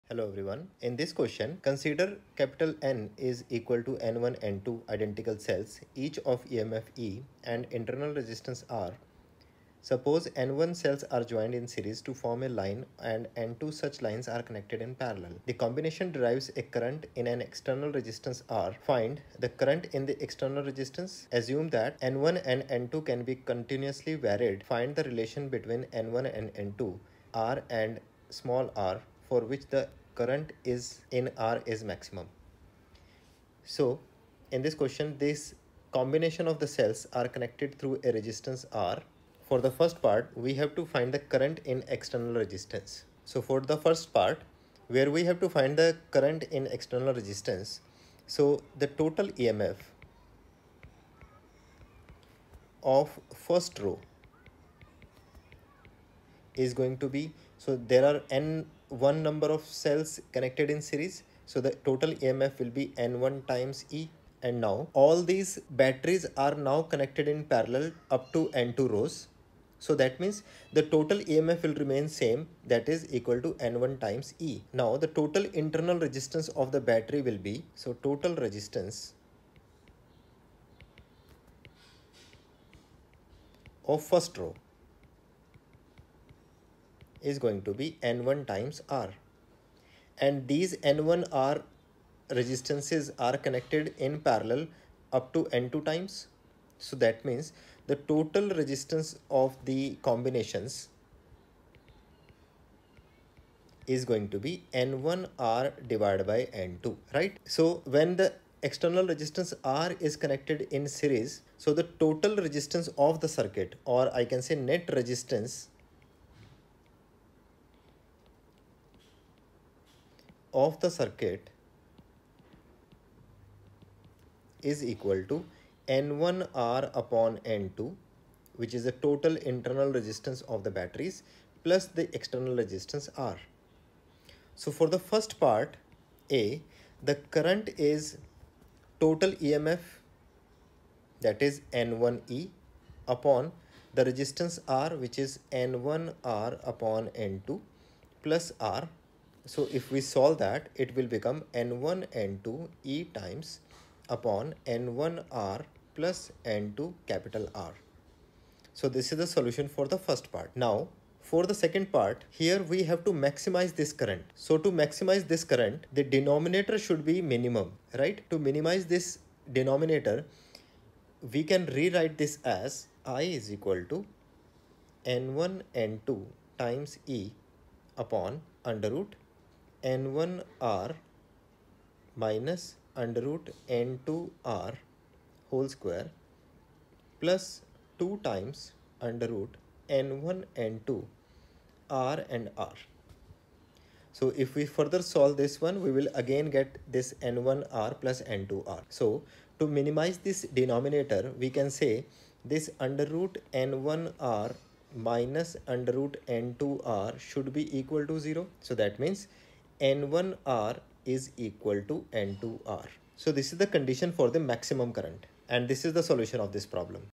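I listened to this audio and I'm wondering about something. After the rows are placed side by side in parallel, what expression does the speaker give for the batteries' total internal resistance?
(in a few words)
N1r/N2.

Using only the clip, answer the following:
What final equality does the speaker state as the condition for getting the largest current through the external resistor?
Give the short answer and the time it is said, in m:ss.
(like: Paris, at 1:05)
N1r = N2R, at 3:29.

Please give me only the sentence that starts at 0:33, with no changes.
So in this question, this combination of the cells are connected through a resistance R.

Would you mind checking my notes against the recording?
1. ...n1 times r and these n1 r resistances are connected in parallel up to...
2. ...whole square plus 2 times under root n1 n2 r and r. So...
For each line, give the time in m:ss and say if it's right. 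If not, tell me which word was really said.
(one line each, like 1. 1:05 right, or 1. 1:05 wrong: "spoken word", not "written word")
1. 1:28 right
2. 3:05 right.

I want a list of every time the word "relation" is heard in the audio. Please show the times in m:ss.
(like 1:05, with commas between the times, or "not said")
0:25.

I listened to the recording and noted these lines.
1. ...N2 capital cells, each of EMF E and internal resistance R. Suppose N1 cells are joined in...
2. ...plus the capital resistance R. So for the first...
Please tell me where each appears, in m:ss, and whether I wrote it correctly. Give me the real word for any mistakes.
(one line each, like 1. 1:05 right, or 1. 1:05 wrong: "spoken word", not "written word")
1. 0:04 wrong: "identical", not "capital"
2. 2:11 wrong: "external", not "capital".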